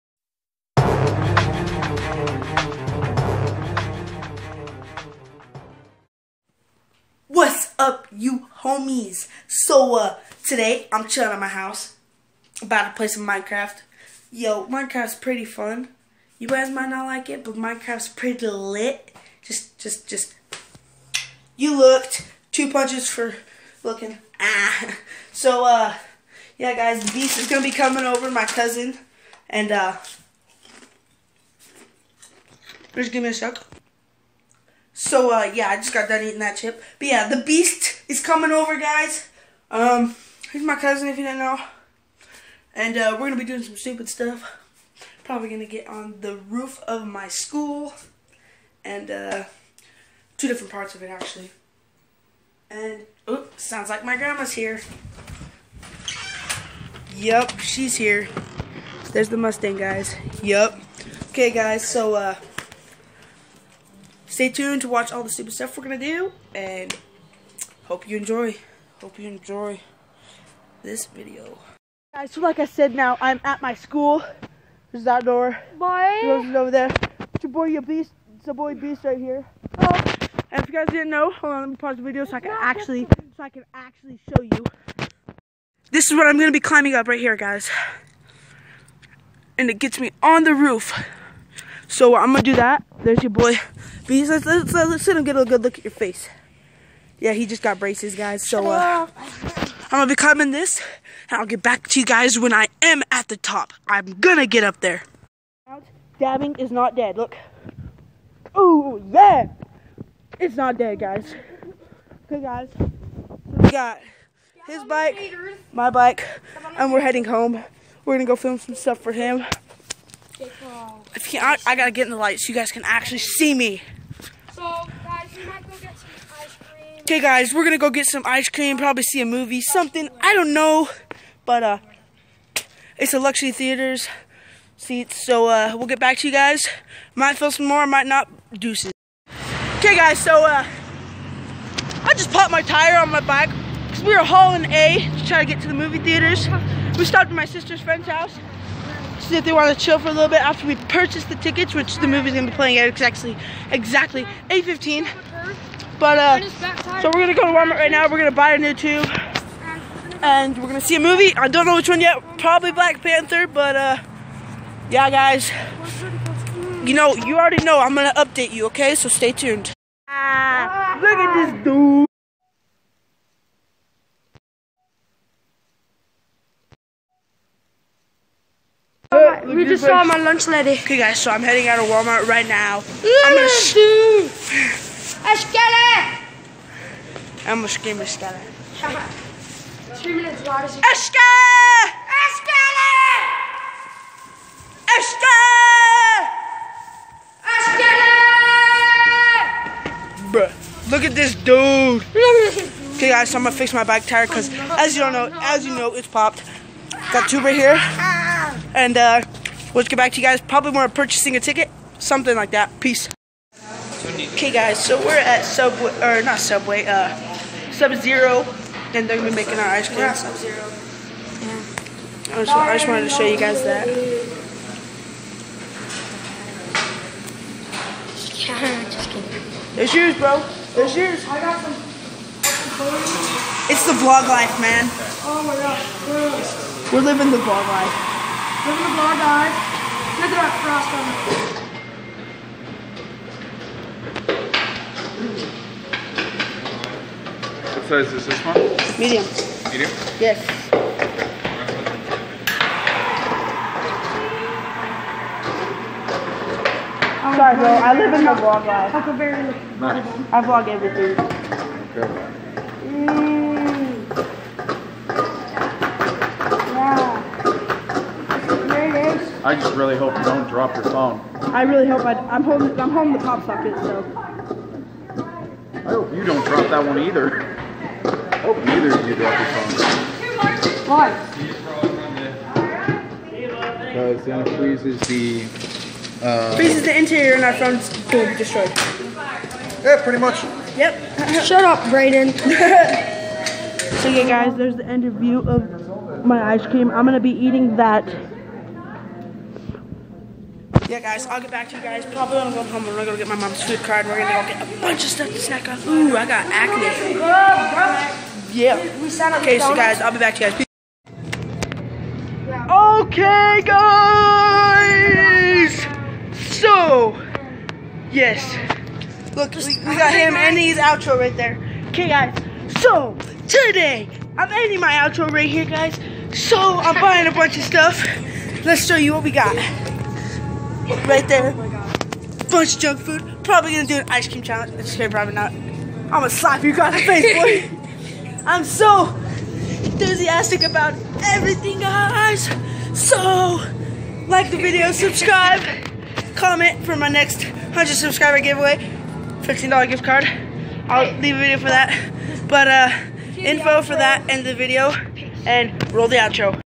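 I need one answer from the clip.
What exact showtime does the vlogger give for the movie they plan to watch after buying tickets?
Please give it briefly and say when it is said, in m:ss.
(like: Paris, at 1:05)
8:15, at 2:34.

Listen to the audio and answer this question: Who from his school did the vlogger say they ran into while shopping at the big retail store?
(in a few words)
Lunch Lady.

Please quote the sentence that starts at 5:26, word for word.
So, I'm buying a bunch of stuff.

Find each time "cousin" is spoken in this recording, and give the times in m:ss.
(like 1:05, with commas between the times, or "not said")
0:28, 0:40.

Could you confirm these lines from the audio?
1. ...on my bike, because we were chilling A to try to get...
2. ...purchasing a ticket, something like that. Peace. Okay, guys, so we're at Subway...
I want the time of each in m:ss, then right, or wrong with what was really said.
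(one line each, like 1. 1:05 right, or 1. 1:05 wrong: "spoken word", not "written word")
1. 2:22 wrong: "hauling", not "chilling"
2. 3:30 right.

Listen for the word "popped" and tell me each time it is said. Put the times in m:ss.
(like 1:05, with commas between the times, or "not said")
2:22, 3:26.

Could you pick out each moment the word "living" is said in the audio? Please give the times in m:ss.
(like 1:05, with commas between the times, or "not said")
3:57.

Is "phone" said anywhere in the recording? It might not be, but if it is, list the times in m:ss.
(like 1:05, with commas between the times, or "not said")
4:30, 4:39, 4:47.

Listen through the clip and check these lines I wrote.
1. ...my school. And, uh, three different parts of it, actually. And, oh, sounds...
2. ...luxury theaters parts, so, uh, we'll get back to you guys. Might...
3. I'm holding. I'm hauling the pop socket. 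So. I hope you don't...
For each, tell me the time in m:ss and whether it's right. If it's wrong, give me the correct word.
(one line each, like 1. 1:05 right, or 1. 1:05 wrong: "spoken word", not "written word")
1. 0:47 wrong: "two", not "three"
2. 2:13 wrong: "seats", not "parts"
3. 4:32 wrong: "holding", not "hauling".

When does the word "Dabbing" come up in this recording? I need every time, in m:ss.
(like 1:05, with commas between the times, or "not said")
1:46.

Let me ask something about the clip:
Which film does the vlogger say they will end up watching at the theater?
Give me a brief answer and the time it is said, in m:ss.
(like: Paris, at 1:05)
Black Panther, at 2:42.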